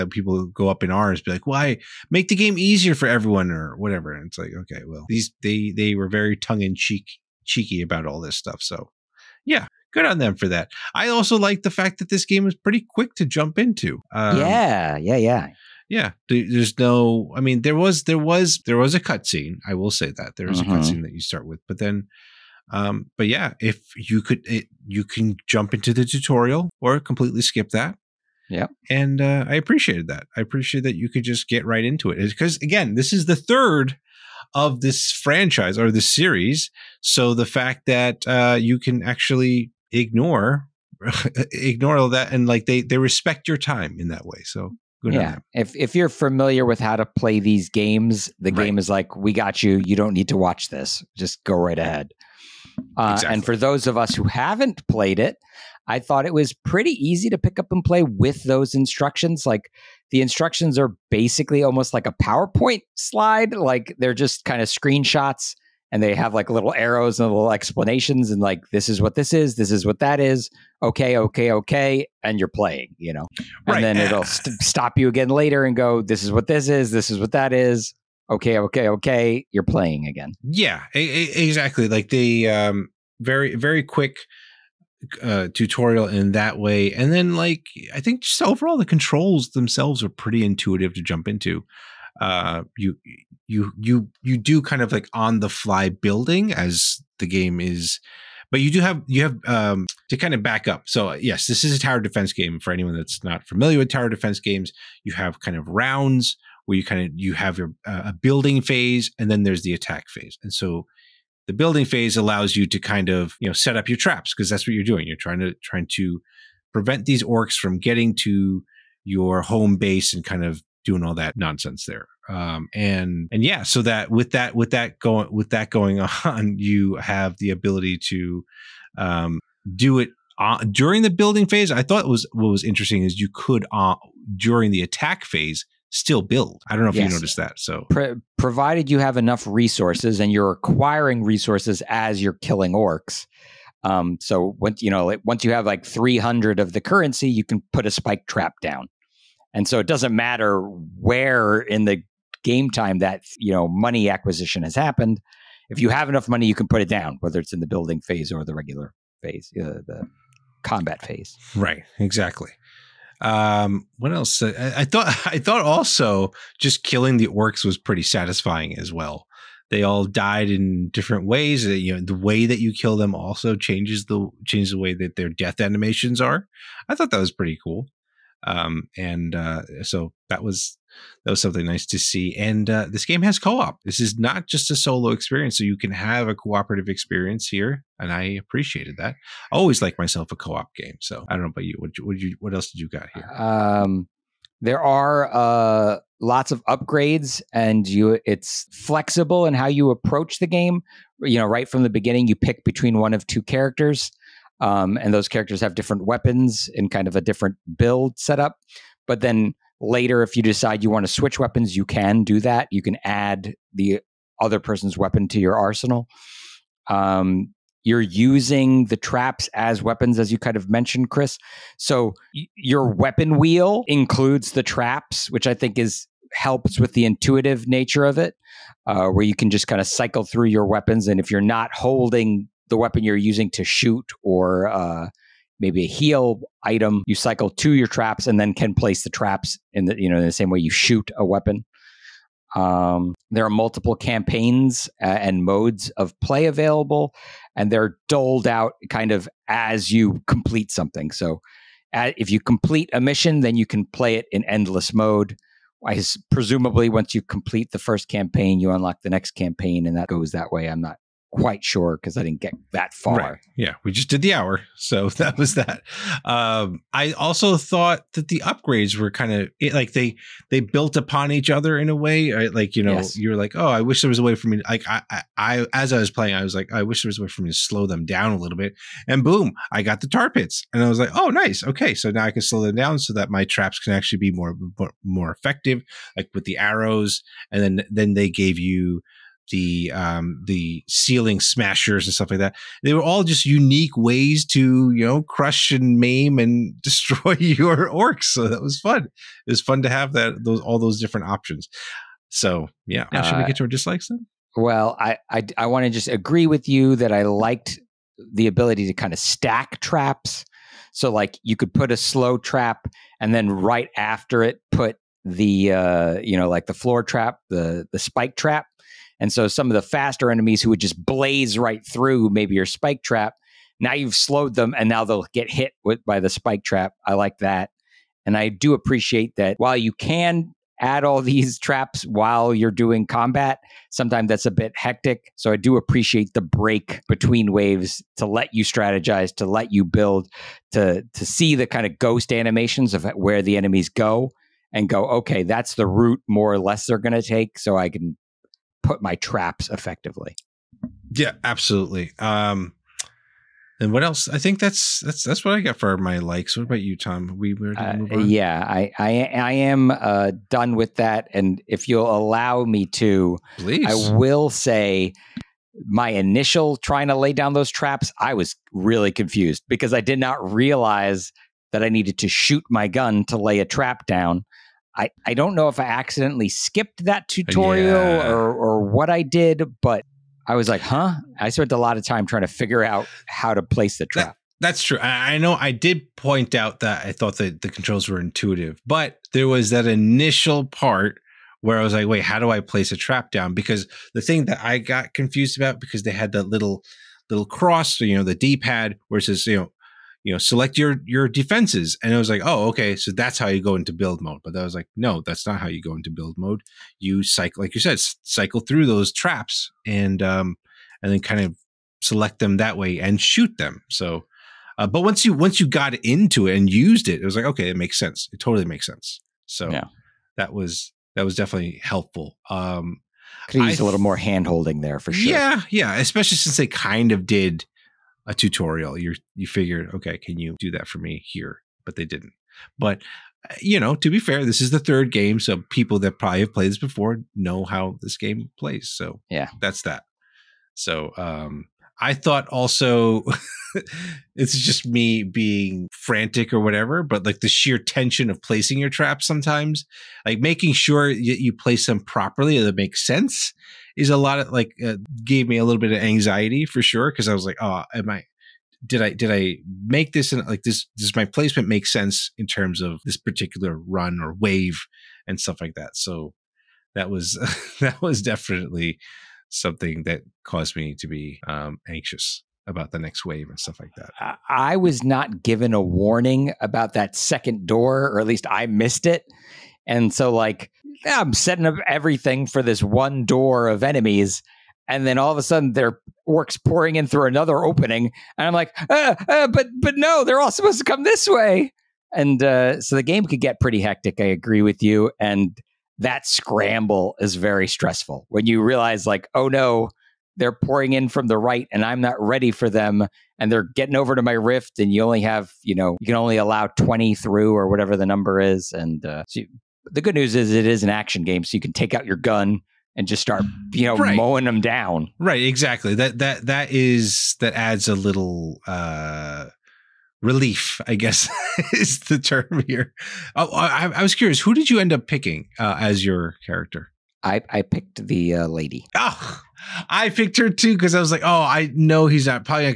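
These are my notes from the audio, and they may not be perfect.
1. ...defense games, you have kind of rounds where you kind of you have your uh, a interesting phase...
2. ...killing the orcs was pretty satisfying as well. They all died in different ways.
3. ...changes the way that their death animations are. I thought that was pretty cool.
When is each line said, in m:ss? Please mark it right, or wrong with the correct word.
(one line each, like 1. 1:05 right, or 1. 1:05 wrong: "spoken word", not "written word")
1. 1:44 wrong: "building", not "interesting"
2. 2:46 right
3. 2:54 right.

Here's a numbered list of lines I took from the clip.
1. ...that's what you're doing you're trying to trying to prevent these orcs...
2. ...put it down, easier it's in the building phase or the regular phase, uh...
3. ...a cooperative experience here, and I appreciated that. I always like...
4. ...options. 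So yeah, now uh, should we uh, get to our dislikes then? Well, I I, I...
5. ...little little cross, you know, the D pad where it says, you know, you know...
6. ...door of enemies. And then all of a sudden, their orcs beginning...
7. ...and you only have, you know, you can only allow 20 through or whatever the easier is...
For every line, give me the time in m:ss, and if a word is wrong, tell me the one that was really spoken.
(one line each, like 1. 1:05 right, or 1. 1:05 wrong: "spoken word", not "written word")
1. 1:54 right
2. 2:36 wrong: "whether", not "easier"
3. 3:06 right
4. 5:01 right
5. 6:36 right
6. 8:03 wrong: "pouring", not "beginning"
7. 8:24 wrong: "number", not "easier".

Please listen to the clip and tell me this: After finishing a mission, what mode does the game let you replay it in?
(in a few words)
endless mode.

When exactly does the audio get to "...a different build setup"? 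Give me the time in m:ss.
3:27.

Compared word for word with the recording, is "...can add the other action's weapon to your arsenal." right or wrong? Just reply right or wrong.
wrong.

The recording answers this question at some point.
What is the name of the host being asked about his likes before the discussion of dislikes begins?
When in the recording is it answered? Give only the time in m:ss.
5:56.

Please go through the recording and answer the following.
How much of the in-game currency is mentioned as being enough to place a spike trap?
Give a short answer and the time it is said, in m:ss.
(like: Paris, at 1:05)
300, at 2:25.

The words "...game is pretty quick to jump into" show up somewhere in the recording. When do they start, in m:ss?
0:12.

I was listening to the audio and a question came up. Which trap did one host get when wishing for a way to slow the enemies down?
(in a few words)
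tar pits.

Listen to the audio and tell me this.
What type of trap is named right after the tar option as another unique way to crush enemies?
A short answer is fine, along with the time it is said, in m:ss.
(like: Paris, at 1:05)
ceiling smashers, at 4:50.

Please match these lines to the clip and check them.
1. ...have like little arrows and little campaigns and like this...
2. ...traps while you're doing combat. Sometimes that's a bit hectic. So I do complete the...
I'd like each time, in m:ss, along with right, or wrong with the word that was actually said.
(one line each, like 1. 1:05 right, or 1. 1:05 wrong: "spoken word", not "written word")
1. 1:06 wrong: "explanations", not "campaigns"
2. 5:31 wrong: "appreciate", not "complete".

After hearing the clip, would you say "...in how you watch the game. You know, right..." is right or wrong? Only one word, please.
wrong.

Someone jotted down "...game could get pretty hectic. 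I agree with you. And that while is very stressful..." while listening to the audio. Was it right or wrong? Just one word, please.
wrong.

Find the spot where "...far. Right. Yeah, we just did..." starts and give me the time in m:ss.
4:22.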